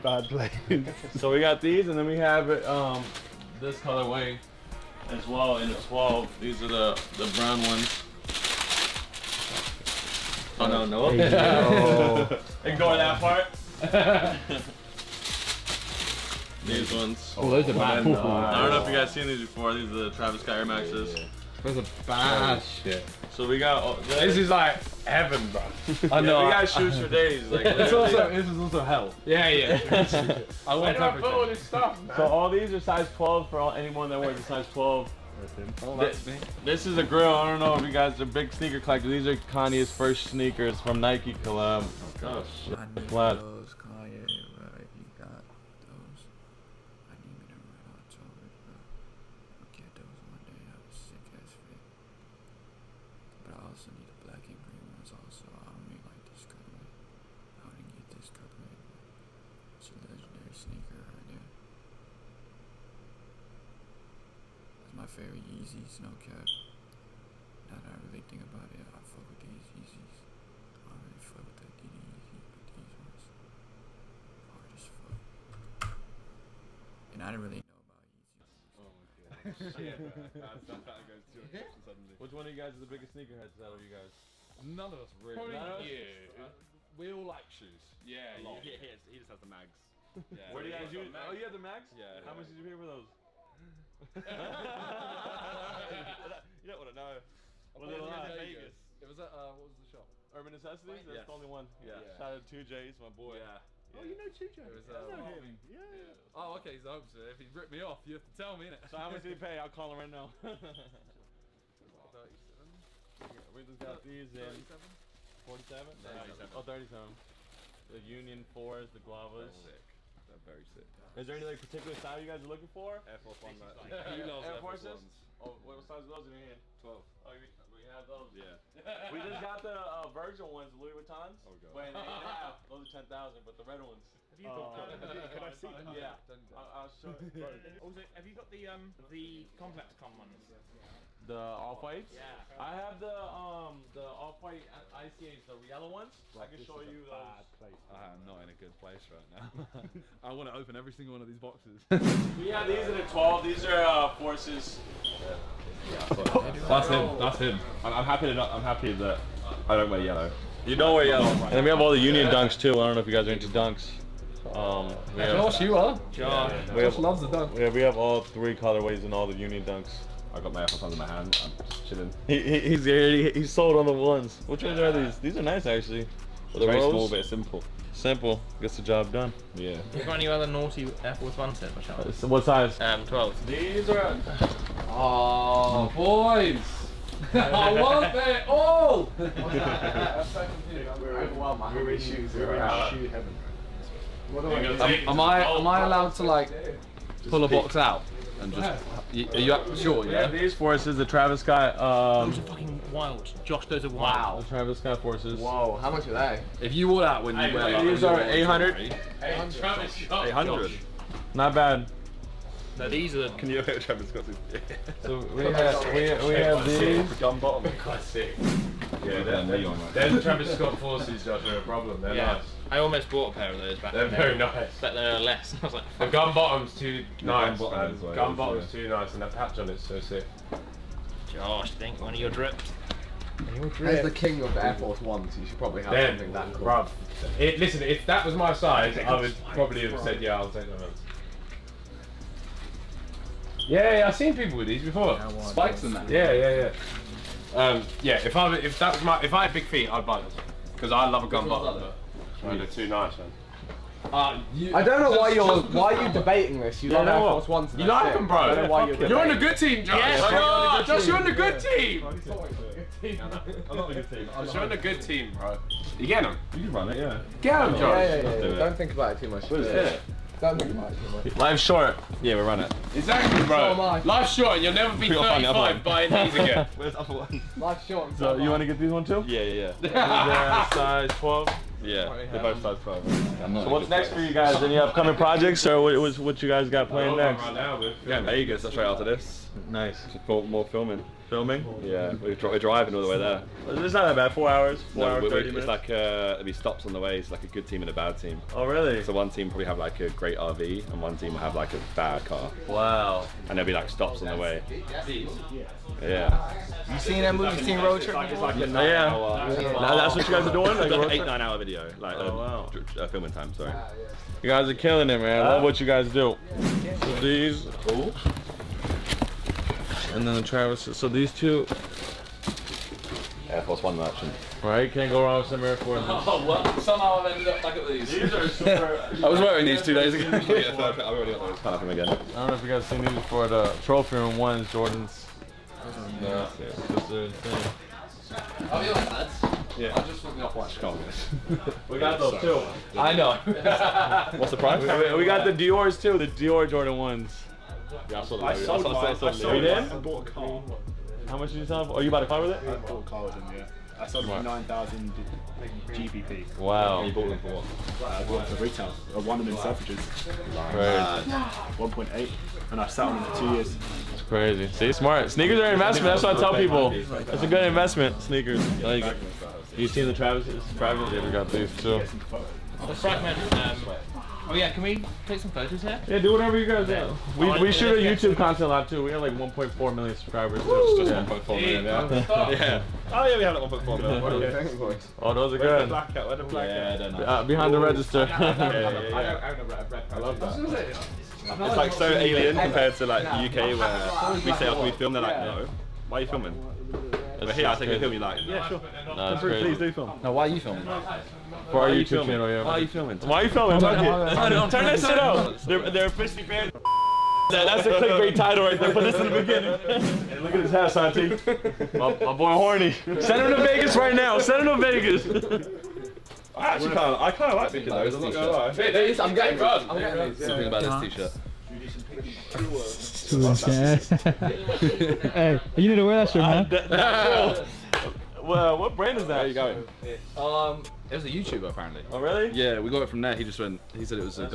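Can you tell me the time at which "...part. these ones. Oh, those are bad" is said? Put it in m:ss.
0:13.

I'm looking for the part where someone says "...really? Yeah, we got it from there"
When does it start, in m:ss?
7:12.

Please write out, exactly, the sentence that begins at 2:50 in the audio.
I got my apples under my hand.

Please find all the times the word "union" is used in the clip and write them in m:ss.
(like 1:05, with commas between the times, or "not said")
1:58, 2:41, 2:49.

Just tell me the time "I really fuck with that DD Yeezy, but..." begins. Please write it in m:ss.
1:10.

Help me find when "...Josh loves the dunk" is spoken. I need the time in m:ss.
2:46.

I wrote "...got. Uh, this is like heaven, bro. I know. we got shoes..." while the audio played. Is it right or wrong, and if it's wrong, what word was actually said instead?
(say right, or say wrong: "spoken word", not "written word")
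right.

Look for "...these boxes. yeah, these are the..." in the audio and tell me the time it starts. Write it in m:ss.
2:31.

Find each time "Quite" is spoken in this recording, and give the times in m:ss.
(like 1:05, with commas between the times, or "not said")
3:37.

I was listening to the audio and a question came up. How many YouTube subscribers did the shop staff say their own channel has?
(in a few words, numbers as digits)
1.4 million.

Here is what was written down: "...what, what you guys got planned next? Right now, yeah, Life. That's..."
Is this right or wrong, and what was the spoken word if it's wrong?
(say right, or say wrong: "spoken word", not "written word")
wrong: "Vegas", not "Life".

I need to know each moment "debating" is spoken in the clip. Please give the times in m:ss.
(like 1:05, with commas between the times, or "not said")
4:16.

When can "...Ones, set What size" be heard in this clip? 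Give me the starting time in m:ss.
3:01.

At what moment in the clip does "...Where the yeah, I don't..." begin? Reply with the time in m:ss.
6:26.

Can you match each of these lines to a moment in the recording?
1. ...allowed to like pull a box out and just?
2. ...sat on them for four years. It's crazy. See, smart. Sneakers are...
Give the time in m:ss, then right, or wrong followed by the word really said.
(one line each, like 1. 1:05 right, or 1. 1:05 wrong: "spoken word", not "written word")
1. 3:15 right
2. 6:02 wrong: "two", not "four".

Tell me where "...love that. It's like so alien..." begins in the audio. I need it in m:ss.
6:30.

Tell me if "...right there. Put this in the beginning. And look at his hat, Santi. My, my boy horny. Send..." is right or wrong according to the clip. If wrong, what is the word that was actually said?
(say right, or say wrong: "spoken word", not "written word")
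right.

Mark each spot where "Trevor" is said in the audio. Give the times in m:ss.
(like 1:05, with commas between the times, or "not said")
3:33.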